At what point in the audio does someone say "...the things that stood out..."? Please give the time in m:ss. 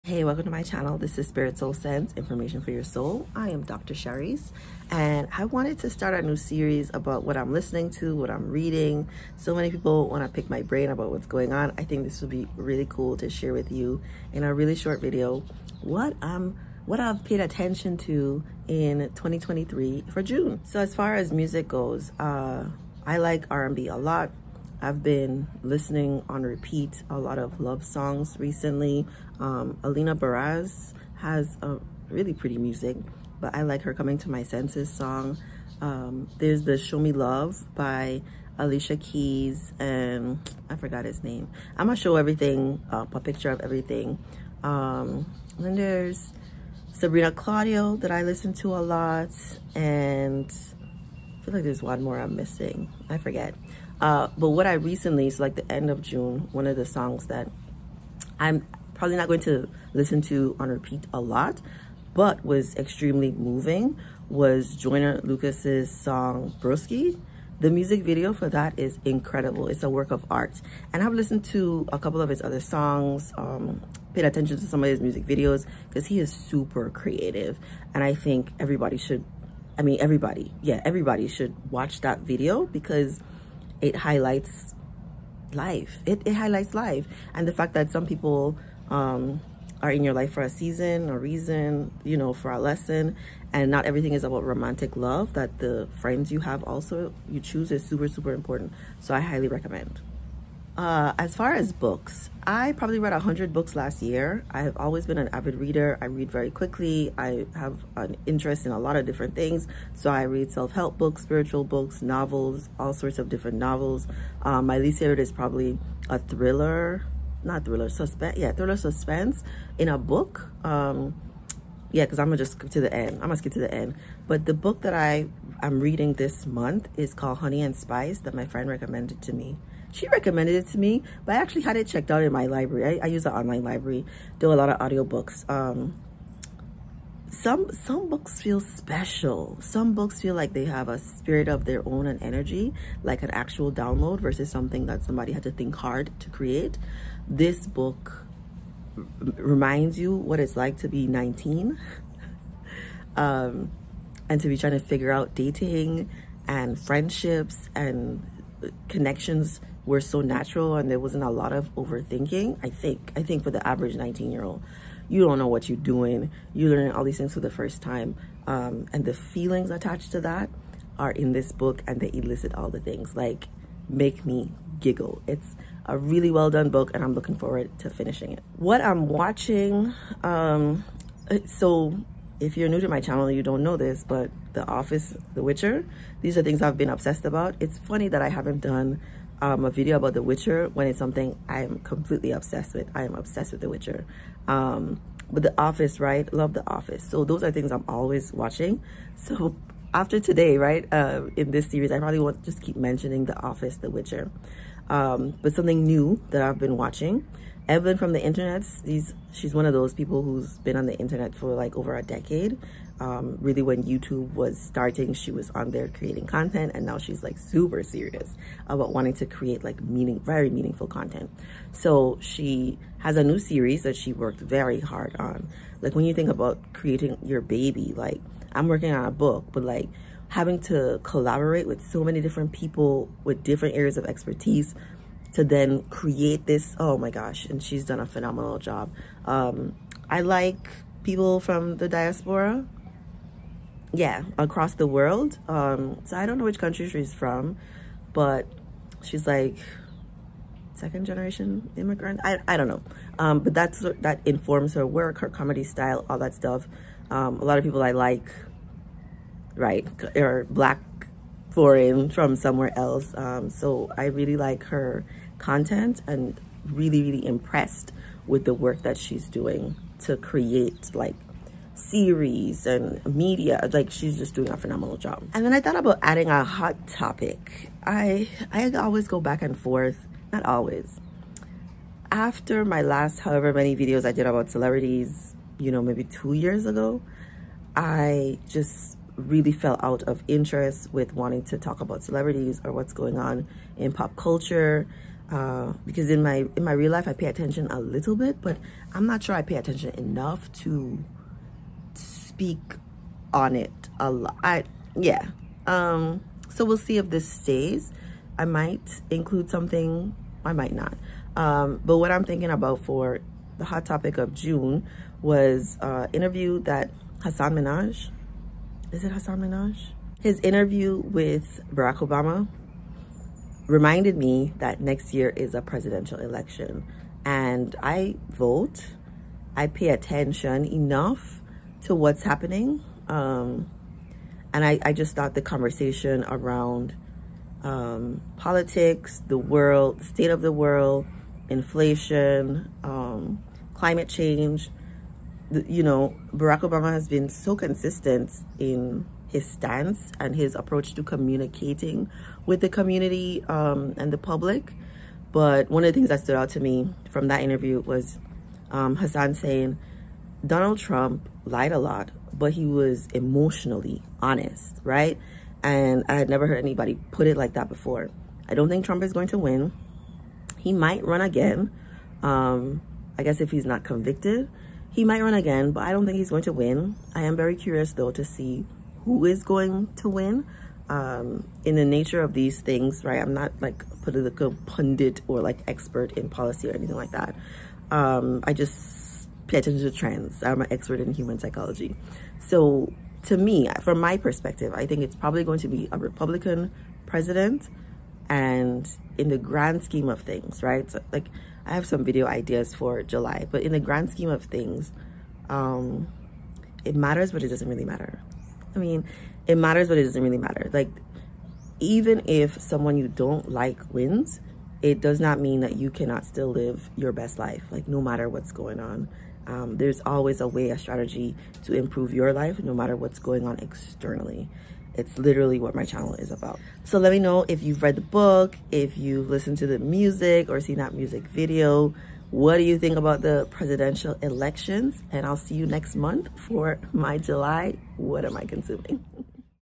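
5:55.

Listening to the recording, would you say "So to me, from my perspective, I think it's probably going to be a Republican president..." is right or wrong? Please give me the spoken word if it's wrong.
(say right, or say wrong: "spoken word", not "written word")
right.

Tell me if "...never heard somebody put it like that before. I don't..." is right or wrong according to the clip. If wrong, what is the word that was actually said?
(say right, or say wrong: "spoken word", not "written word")
wrong: "anybody", not "somebody".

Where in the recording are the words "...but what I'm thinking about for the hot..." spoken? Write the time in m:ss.
5:11.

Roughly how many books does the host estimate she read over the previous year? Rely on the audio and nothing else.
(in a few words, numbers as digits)
100.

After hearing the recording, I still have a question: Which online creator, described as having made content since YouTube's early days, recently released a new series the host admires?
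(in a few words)
Evelyn from the internet.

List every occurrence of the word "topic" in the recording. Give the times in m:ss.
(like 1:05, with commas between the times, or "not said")
4:36, 5:13.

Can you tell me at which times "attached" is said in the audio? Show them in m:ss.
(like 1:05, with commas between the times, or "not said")
2:49.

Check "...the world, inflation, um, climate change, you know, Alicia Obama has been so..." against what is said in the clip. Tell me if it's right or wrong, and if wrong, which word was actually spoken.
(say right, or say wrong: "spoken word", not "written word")
wrong: "Barack", not "Alicia".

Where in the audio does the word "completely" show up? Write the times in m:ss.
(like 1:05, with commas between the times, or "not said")
3:11.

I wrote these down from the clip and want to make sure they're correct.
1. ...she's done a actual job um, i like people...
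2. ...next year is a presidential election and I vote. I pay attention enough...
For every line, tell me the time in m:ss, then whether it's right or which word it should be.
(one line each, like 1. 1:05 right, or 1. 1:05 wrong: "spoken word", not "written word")
1. 3:57 wrong: "phenomenal", not "actual"
2. 5:24 right.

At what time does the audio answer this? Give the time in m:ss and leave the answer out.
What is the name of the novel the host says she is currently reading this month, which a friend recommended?
2:07.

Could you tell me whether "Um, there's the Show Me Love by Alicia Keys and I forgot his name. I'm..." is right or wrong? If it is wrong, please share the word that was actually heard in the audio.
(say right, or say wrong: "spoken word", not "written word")
right.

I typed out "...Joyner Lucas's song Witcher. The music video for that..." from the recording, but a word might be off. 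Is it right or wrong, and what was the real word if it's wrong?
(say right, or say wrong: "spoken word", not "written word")
wrong: "Broski", not "Witcher".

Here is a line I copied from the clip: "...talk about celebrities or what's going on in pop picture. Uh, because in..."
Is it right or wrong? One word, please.
wrong.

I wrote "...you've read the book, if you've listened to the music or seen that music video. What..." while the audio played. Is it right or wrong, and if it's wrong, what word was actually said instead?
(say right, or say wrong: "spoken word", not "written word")
right.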